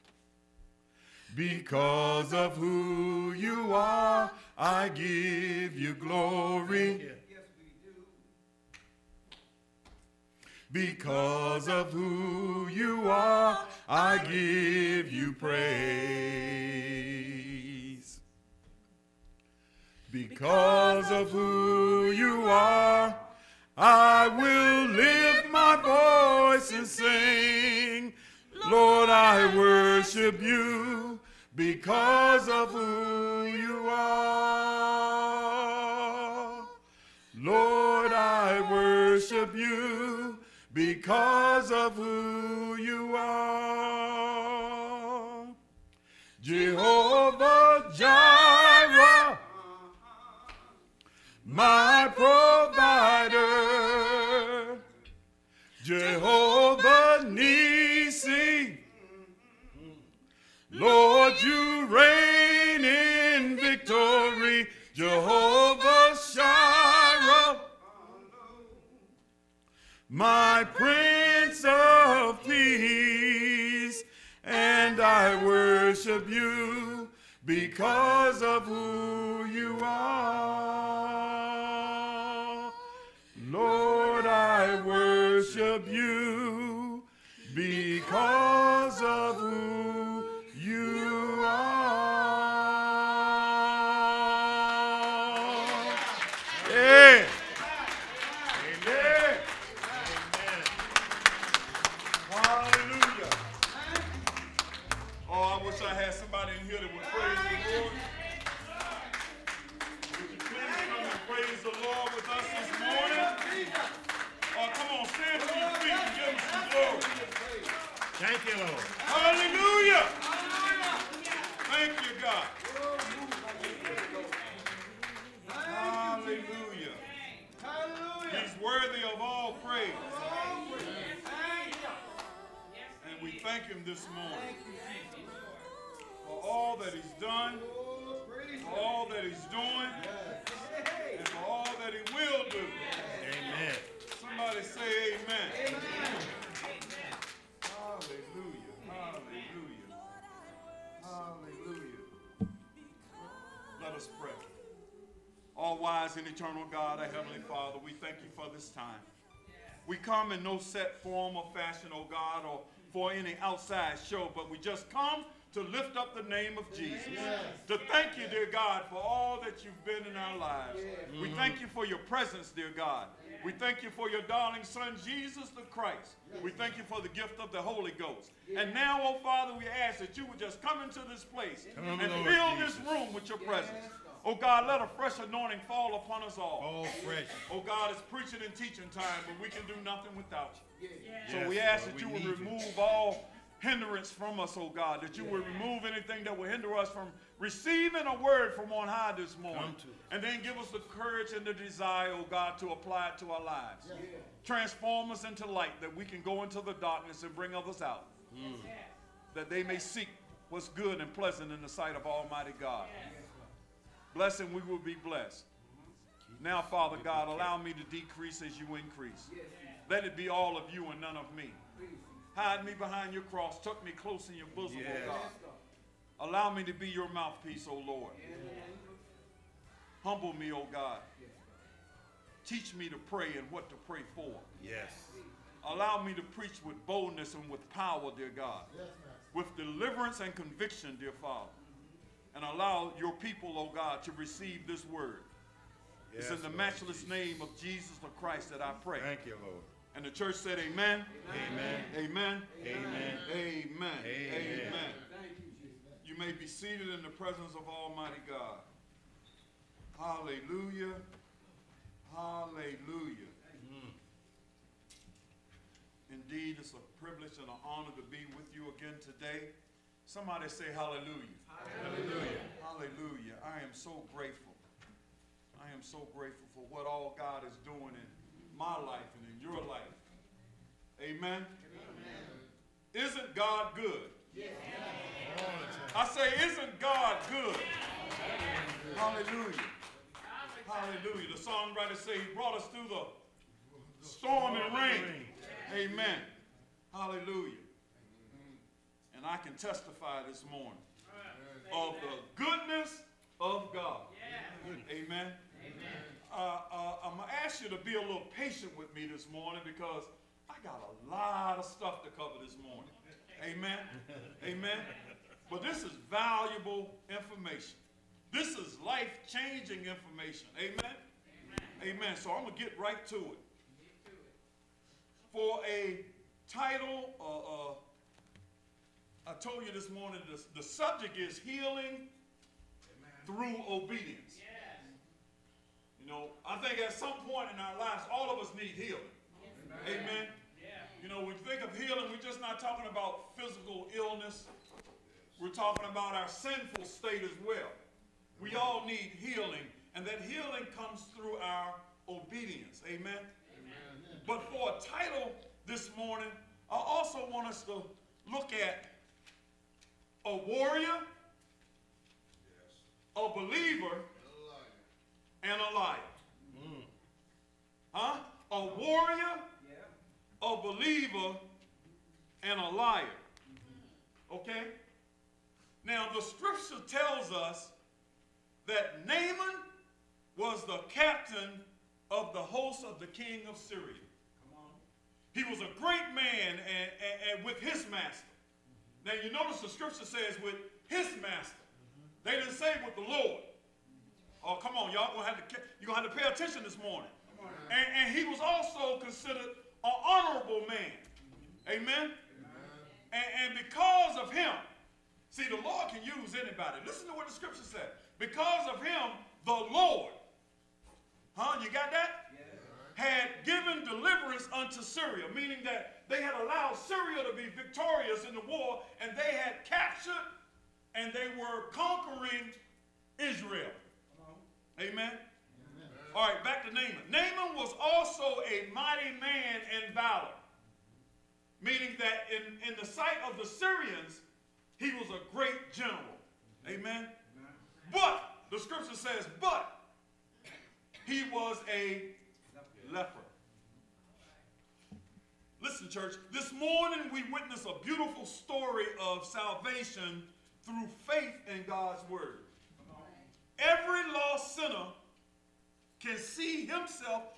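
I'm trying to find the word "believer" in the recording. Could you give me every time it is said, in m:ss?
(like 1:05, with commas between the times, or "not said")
6:03, 6:10.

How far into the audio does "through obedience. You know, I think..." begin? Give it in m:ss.
5:33.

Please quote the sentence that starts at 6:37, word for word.
And, and, he was also considered an honorable man.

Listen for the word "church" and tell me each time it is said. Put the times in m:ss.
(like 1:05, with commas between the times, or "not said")
4:10, 7:25.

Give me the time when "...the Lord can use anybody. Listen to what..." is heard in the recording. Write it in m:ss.
6:45.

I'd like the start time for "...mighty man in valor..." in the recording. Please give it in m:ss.
7:08.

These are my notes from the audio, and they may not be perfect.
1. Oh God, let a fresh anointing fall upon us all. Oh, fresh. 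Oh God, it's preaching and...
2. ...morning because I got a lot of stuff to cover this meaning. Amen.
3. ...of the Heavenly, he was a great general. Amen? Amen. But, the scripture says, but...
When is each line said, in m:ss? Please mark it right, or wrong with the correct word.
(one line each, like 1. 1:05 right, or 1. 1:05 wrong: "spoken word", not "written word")
1. 3:04 right
2. 5:09 wrong: "morning", not "meaning"
3. 7:13 wrong: "Syrians", not "Heavenly".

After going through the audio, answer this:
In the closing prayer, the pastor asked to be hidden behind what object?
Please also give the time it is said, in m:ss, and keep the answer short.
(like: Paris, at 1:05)
Your cross, at 3:42.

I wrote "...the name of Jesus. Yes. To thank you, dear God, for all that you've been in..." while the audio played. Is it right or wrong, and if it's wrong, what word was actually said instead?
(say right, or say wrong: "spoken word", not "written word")
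right.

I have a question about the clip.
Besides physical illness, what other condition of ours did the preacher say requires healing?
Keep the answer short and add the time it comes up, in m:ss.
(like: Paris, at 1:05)
Our sinful state, at 5:46.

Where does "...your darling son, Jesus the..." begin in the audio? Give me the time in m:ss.
2:54.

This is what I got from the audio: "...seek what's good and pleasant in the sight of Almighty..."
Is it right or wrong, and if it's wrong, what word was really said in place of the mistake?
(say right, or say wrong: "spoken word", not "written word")
right.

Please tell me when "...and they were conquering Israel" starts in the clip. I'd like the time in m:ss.
7:00.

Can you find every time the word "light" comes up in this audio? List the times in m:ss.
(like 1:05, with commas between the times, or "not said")
3:25, 6:05.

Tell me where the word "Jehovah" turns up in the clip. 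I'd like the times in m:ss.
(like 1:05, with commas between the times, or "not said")
0:46, 0:55, 1:04.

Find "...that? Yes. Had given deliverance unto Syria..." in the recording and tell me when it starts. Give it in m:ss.
6:51.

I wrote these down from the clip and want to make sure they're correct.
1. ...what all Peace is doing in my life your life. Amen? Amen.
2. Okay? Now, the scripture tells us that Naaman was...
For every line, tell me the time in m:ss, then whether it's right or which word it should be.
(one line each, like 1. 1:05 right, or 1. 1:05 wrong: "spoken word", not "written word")
1. 4:36 wrong: "God", not "Peace"
2. 6:14 right.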